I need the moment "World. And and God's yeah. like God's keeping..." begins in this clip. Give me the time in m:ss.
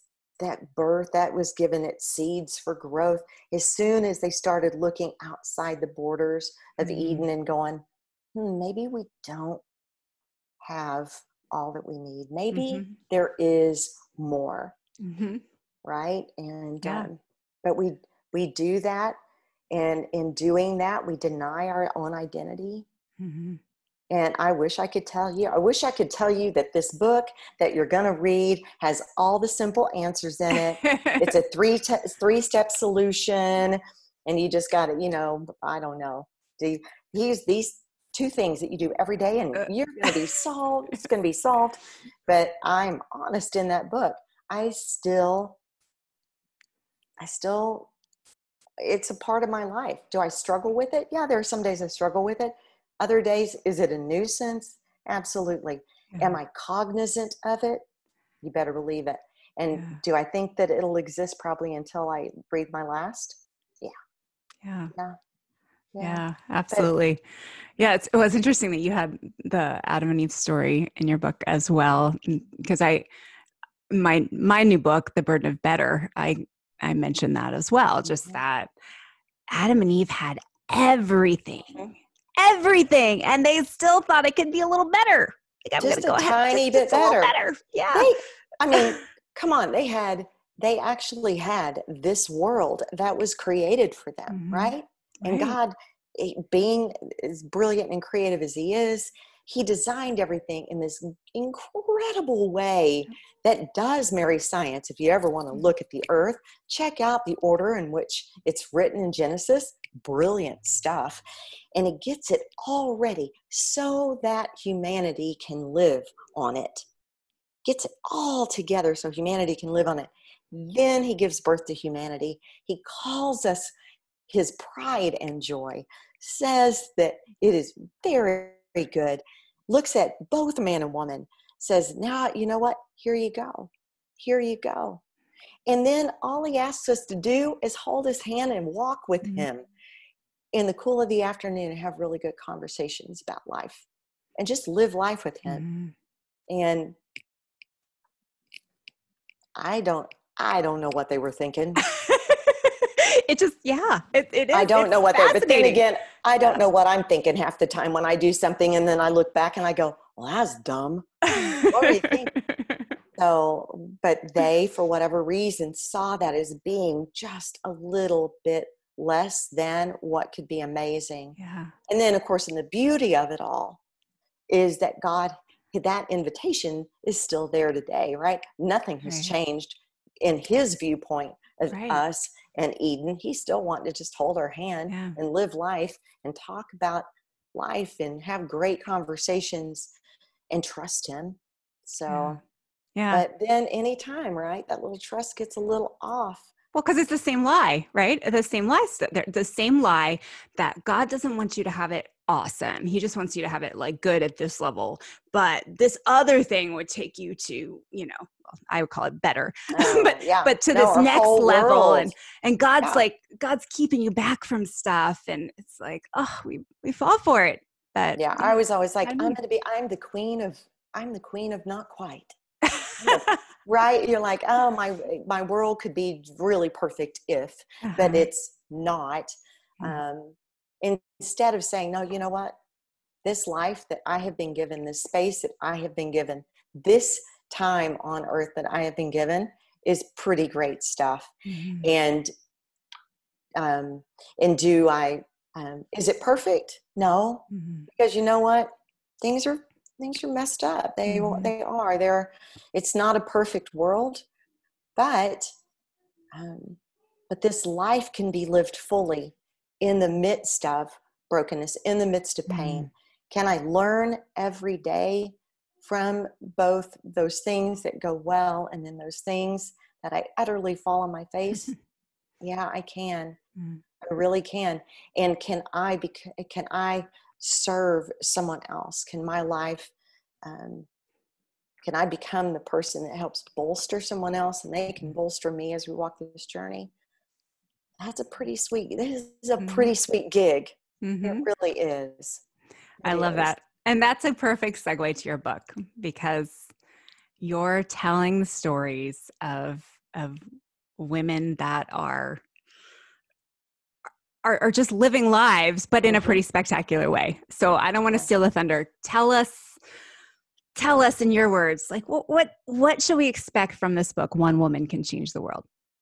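3:31.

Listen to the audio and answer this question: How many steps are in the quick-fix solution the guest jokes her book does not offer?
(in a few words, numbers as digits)
3.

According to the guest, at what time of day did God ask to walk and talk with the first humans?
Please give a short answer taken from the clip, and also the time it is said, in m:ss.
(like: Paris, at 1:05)
the cool of the afternoon, at 2:20.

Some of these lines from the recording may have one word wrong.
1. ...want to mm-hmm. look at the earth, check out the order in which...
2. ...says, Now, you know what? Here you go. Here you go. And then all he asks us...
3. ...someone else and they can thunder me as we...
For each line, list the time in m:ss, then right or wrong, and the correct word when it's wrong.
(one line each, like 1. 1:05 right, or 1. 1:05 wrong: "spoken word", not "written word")
1. 1:45 right
2. 2:11 right
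3. 4:43 wrong: "bolster", not "thunder".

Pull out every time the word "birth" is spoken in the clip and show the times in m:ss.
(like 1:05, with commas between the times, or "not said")
0:00, 2:01.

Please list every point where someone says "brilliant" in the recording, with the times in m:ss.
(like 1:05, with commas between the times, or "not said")
1:37, 1:50.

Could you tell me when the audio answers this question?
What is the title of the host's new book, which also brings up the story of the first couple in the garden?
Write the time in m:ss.
1:15.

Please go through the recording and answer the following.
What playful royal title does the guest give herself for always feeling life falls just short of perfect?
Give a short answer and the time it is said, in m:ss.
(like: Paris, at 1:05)
queen of not quite, at 3:41.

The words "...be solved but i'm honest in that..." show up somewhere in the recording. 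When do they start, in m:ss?
0:41.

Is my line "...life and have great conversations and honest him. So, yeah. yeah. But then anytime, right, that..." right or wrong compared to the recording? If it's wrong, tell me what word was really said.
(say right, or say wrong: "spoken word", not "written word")
wrong: "trust", not "honest".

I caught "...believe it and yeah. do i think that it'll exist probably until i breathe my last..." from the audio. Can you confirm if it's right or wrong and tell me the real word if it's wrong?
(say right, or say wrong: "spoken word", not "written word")
right.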